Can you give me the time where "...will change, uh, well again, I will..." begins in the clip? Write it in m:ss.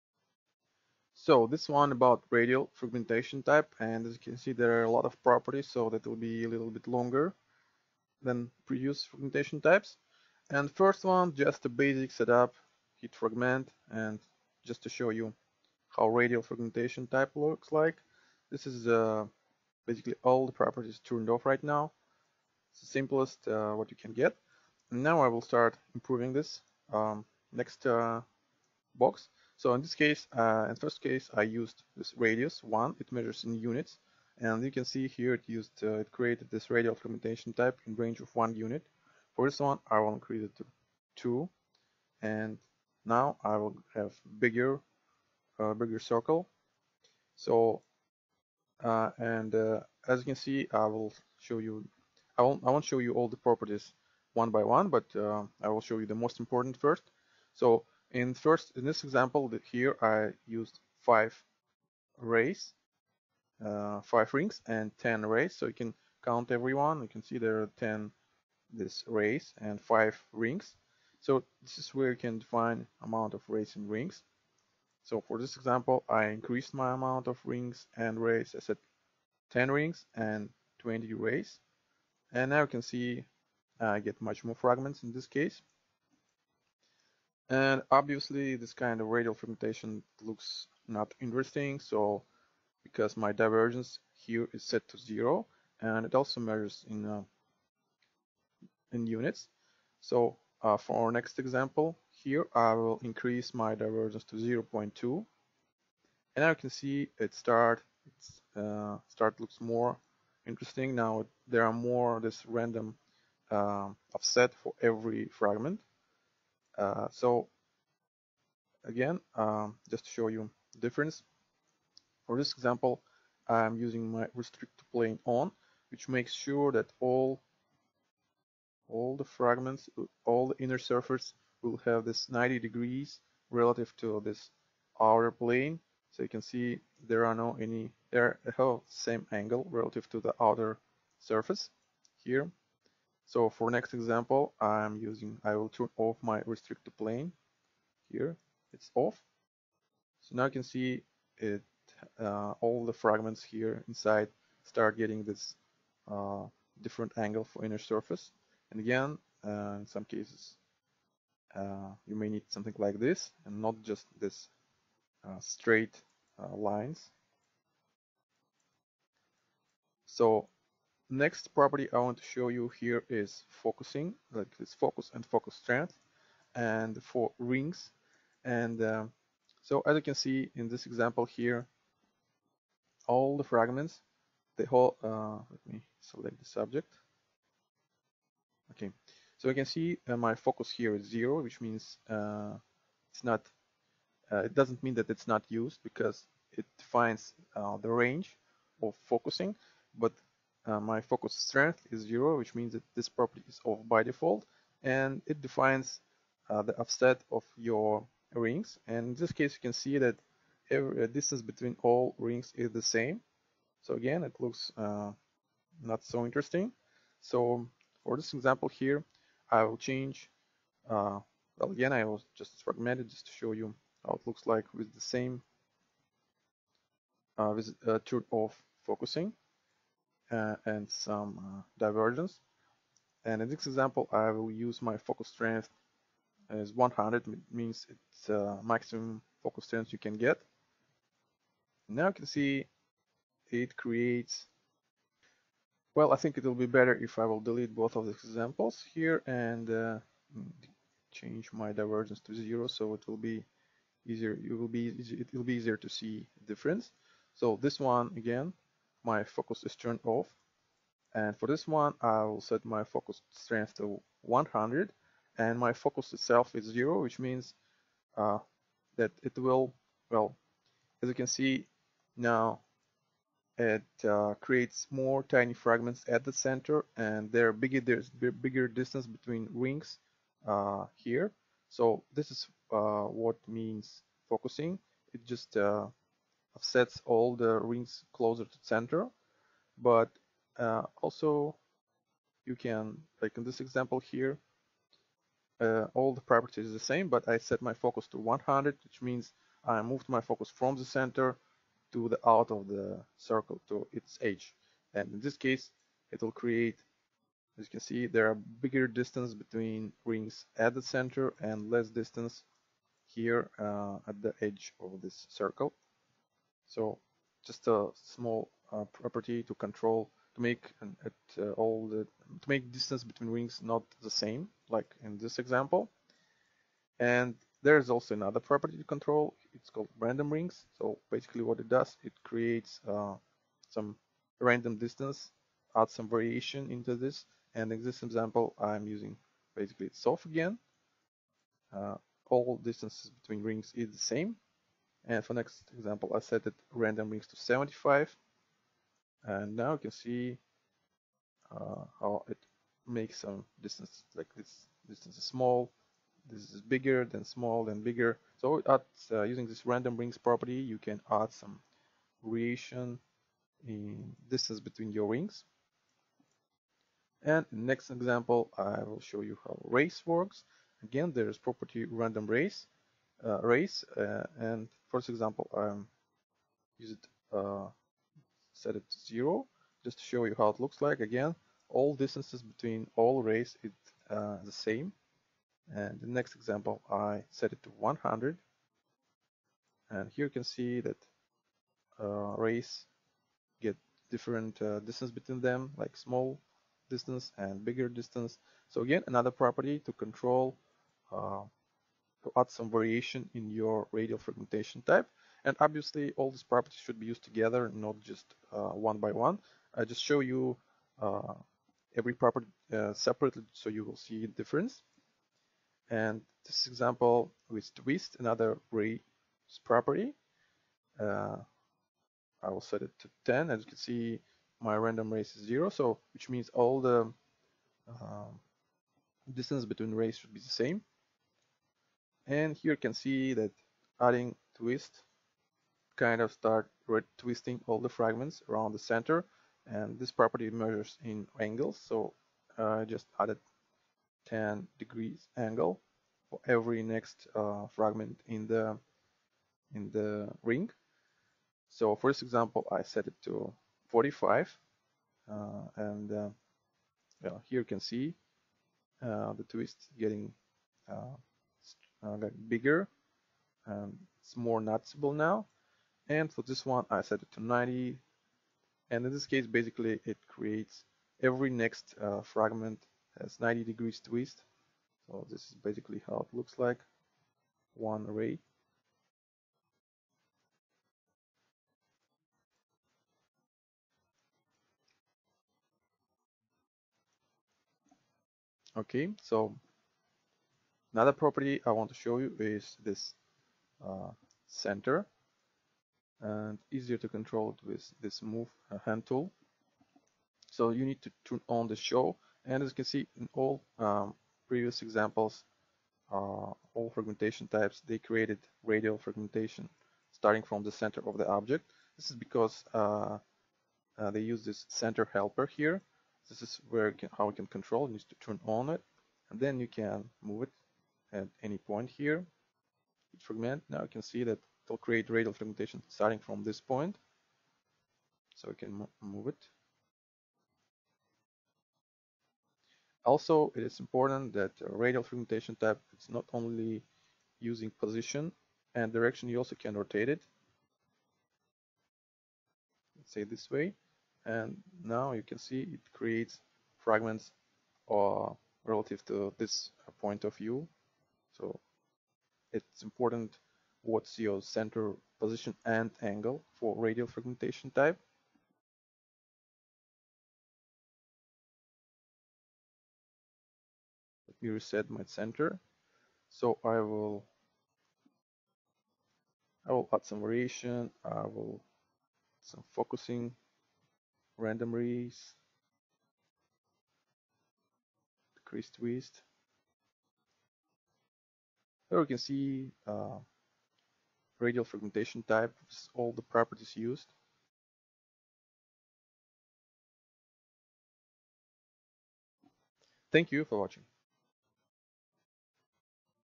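3:39.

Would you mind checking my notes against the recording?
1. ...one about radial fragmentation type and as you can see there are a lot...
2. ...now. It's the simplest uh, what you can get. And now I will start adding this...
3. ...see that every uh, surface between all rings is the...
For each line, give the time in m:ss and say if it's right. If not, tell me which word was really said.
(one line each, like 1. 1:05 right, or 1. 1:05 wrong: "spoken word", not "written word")
1. 0:01 right
2. 0:21 wrong: "improving", not "adding"
3. 3:29 wrong: "distance", not "surface".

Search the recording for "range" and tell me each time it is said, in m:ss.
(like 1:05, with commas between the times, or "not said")
0:37, 3:17.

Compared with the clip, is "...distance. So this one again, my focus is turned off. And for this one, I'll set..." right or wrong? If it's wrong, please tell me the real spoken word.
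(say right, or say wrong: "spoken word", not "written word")
wrong: "difference", not "distance".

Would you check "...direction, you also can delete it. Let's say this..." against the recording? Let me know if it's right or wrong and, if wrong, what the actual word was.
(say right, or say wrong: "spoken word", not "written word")
wrong: "rotate", not "delete".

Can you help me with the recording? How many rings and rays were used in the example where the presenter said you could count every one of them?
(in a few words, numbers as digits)
5 rings and 10 rays.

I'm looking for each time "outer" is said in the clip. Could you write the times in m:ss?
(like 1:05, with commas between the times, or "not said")
2:14, 2:20.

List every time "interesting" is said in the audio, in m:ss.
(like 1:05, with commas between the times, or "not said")
1:31, 1:50, 3:36.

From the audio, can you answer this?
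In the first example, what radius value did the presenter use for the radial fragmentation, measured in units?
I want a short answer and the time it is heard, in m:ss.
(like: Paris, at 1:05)
1, at 0:32.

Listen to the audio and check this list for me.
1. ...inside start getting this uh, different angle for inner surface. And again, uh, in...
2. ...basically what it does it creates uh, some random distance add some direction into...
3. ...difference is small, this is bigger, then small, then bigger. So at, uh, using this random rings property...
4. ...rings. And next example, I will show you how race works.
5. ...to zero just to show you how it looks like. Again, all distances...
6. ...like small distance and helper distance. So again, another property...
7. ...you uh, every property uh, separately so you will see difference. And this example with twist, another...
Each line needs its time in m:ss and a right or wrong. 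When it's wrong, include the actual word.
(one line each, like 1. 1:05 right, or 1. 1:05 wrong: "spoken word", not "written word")
1. 2:33 right
2. 5:31 wrong: "variation", not "direction"
3. 5:54 wrong: "distance", not "difference"
4. 6:05 right
5. 6:18 right
6. 6:35 wrong: "bigger", not "helper"
7. 6:50 right.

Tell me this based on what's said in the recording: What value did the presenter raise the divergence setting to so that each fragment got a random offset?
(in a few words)
0.2.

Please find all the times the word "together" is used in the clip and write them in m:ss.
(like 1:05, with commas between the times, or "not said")
6:47.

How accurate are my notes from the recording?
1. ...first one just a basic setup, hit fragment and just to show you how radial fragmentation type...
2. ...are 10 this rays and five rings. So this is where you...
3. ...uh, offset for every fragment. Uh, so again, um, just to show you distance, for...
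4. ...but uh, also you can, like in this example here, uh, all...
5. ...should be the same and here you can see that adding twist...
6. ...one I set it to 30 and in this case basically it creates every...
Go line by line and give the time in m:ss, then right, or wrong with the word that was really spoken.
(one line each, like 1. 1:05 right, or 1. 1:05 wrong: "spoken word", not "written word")
1. 0:10 right
2. 1:07 right
3. 1:53 wrong: "difference", not "distance"
4. 4:49 right
5. 7:10 right
6. 7:46 wrong: "90", not "30".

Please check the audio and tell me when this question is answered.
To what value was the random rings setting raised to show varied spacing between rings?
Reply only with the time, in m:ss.
5:47.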